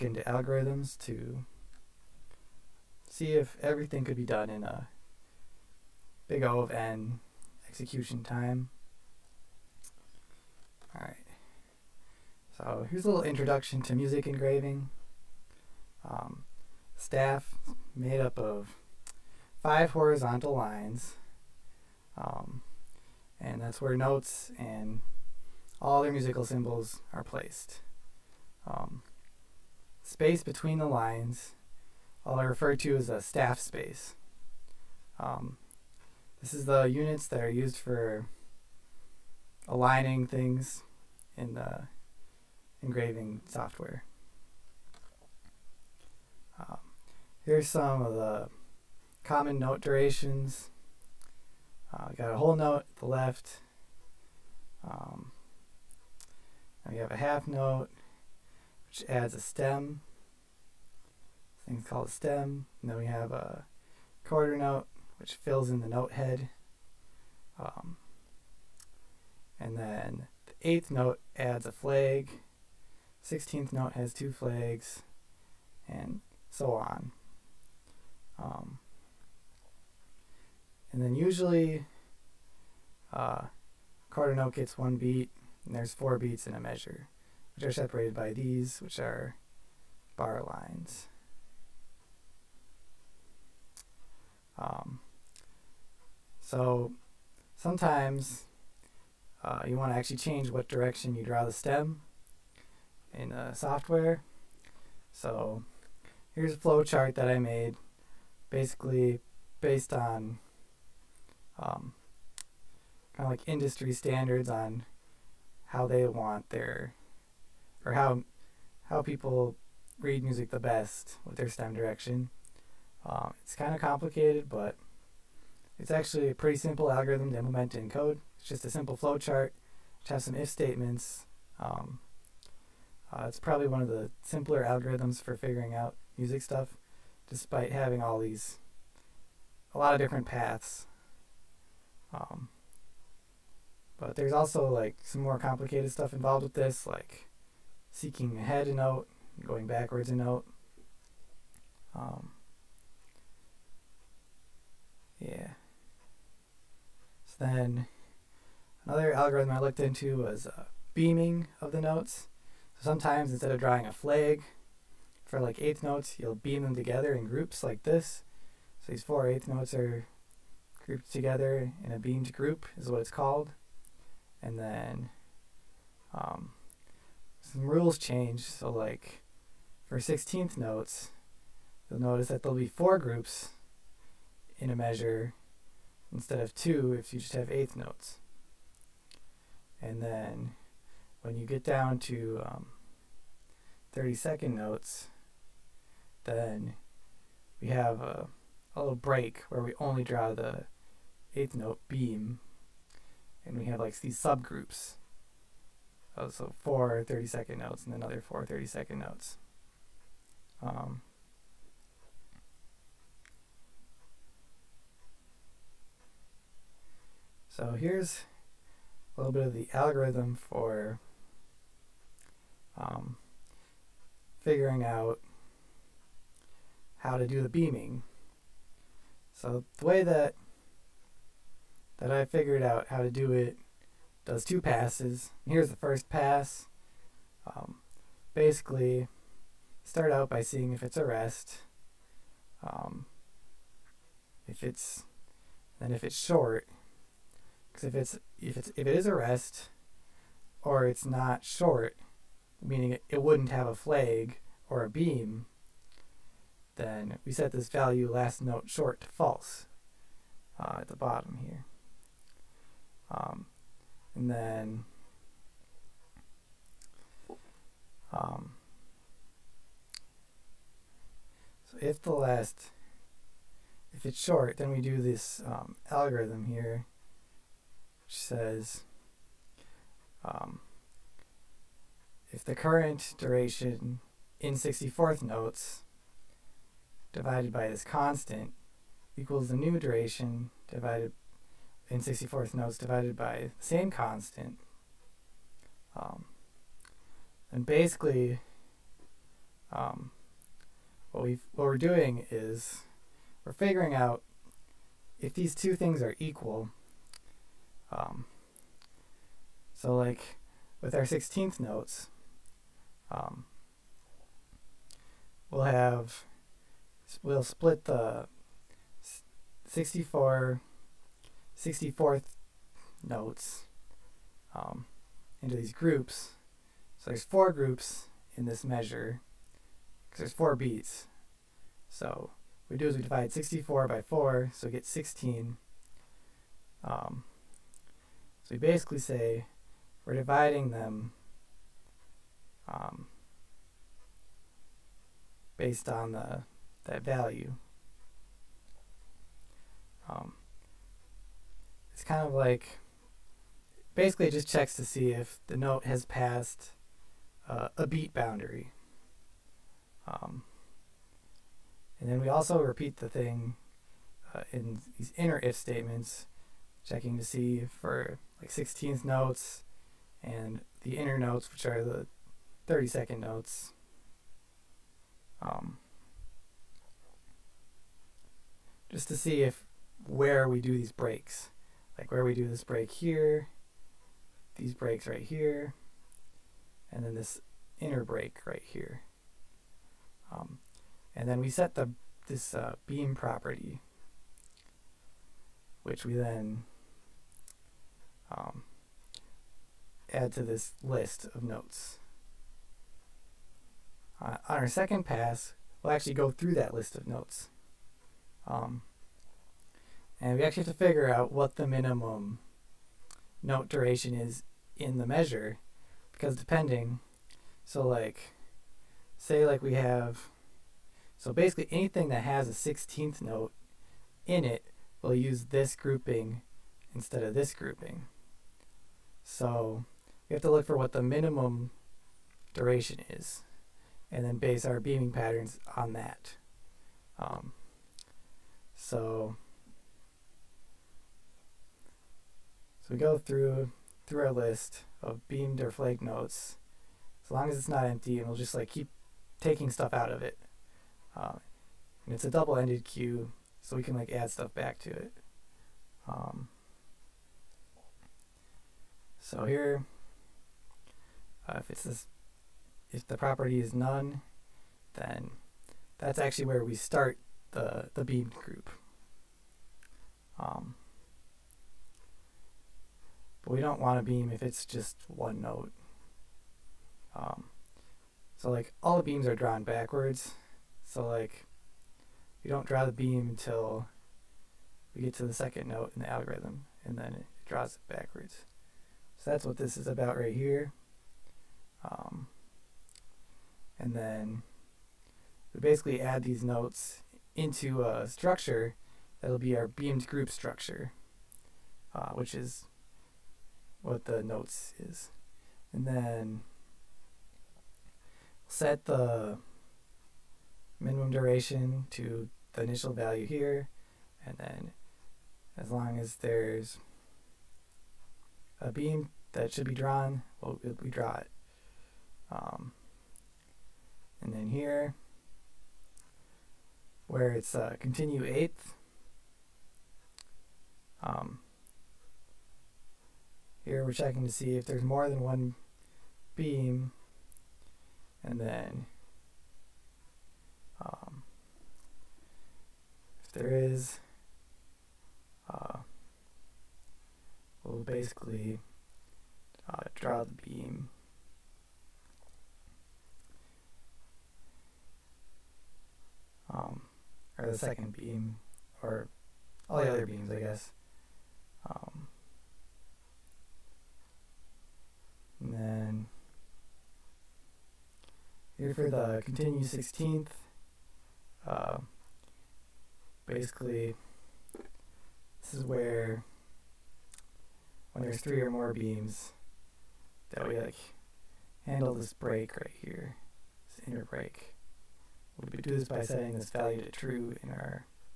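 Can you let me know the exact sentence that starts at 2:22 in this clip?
Um, but there's also like some more complicated stuff involved with this, like seeking ahead a note, going backwards a note.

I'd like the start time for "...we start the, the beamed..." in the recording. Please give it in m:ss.
7:46.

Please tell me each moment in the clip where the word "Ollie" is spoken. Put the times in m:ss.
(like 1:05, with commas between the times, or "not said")
not said.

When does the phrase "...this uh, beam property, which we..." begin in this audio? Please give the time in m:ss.
6:32.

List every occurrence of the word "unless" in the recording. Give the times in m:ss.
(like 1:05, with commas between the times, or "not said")
not said.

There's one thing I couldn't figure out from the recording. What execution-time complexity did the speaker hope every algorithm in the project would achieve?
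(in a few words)
Big O of N.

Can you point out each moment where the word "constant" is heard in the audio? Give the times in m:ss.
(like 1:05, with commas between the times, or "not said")
4:47, 4:53.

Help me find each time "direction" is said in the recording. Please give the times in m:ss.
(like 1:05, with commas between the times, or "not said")
1:40, 2:01.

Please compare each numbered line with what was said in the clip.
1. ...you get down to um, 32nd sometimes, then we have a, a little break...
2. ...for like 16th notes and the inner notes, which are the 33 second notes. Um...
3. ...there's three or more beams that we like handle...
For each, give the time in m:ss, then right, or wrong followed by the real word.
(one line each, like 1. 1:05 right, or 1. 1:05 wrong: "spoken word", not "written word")
1. 3:11 wrong: "notes", not "sometimes"
2. 6:07 wrong: "30", not "33"
3. 9:38 right.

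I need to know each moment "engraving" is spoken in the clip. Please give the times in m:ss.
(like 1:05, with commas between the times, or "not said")
0:14, 0:42.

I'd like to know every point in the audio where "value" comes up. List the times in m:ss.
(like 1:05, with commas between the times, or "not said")
4:17, 5:47, 8:32, 9:46.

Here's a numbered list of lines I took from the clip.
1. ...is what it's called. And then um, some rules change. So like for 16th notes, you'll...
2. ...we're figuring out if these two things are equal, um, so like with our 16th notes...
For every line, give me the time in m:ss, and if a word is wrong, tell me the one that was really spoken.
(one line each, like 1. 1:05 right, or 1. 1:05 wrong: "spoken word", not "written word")
1. 2:52 right
2. 5:03 right.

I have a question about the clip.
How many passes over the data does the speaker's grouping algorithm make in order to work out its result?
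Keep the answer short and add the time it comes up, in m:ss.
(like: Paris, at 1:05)
2, at 3:54.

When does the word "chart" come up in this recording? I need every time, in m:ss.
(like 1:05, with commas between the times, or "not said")
1:46, 2:09.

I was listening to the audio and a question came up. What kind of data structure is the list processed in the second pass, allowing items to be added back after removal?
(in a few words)
Double-ended queue.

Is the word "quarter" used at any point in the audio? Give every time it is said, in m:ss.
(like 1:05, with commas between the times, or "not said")
1:04, 1:24.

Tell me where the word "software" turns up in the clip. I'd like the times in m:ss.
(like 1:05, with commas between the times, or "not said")
0:43, 1:43.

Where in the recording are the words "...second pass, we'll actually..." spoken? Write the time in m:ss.
6:44.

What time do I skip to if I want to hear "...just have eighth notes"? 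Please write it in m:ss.
3:07.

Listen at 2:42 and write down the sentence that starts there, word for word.
So sometimes instead of drawing a flag for like eighth notes, you'll beam them together in groups like this.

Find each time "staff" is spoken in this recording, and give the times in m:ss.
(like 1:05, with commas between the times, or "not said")
0:16, 0:33.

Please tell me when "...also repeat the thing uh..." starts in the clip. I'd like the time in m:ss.
6:02.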